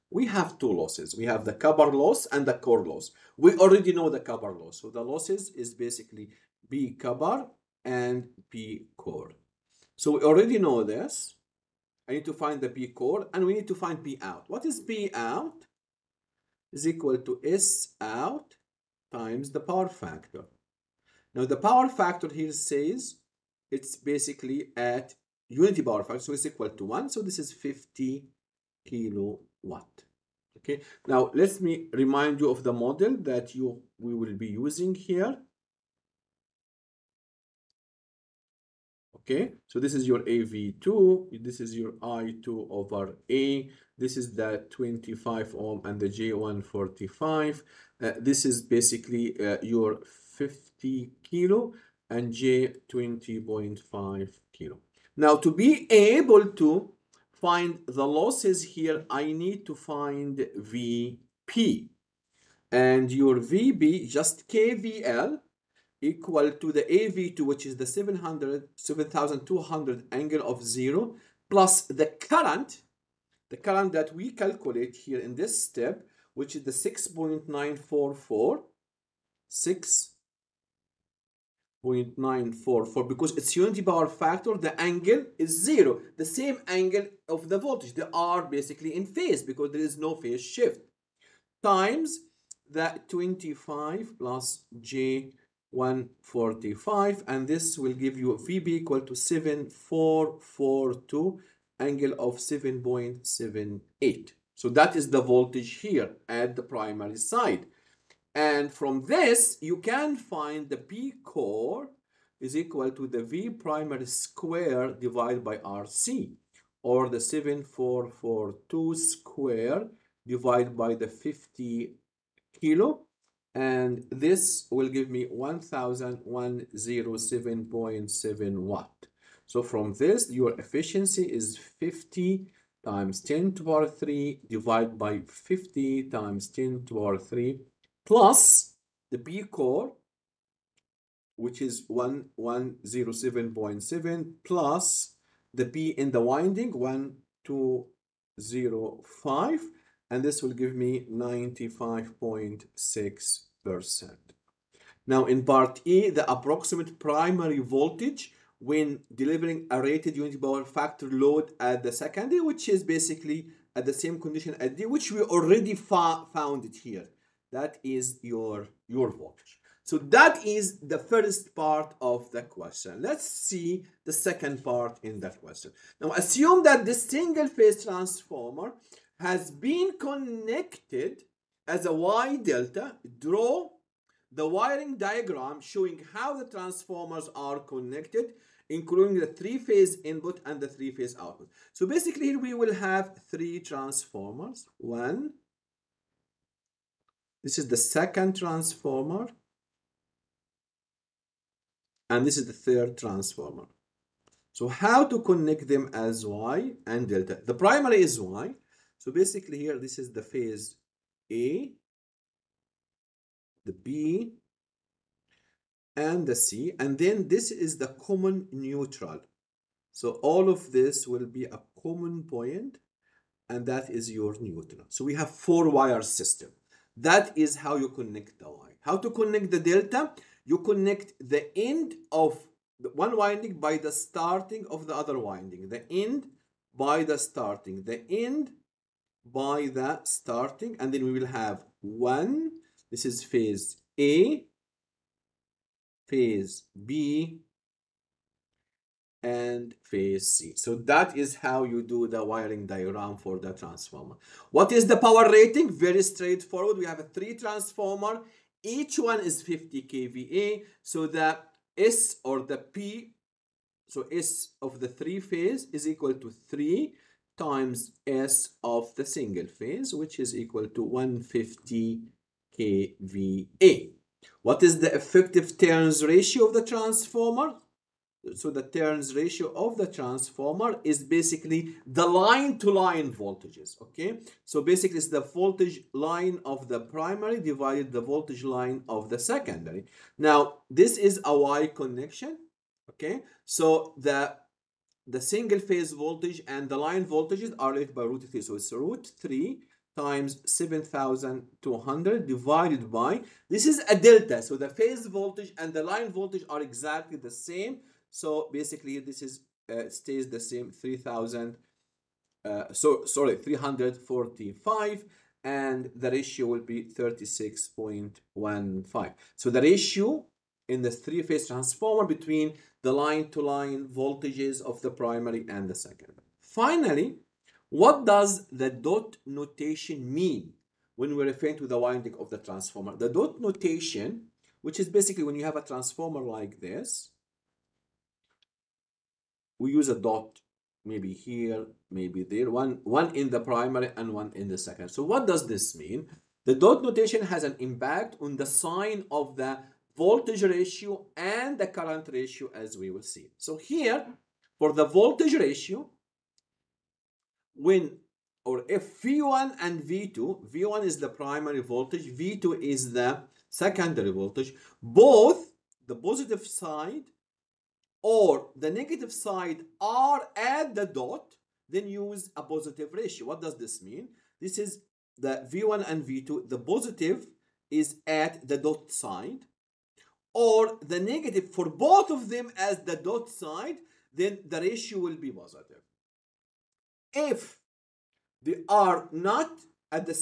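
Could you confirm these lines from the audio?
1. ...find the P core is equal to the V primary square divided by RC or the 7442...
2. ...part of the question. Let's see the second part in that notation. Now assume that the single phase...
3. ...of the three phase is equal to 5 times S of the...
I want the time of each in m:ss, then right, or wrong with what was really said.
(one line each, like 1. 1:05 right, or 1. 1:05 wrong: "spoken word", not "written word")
1. 1:50 right
2. 2:51 wrong: "question", not "notation"
3. 4:24 wrong: "3", not "5".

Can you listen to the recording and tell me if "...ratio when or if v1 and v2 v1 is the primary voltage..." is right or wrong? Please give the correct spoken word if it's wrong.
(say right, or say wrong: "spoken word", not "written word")
right.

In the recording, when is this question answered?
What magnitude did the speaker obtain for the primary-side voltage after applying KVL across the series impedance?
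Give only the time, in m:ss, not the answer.
1:39.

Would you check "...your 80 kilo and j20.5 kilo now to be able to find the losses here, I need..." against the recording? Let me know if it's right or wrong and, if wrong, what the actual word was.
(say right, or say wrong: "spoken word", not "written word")
wrong: "50", not "80".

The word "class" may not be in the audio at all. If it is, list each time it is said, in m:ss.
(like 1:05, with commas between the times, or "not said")
not said.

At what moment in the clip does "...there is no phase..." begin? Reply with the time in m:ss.
1:29.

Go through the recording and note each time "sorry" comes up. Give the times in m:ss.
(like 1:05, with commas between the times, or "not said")
5:13.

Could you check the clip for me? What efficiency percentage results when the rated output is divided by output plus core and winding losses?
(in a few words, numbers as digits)
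95.6%.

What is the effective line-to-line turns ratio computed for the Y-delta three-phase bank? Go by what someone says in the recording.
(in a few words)
36.15.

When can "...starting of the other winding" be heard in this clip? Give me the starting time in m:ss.
3:53.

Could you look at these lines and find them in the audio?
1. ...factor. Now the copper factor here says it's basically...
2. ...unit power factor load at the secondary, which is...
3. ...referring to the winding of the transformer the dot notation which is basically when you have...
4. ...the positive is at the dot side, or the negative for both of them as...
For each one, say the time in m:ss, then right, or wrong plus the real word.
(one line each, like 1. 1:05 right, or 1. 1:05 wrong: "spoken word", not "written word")
1. 0:19 wrong: "power", not "copper"
2. 2:40 right
3. 5:31 right
4. 6:16 right.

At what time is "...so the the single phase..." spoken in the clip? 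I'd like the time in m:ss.
4:53.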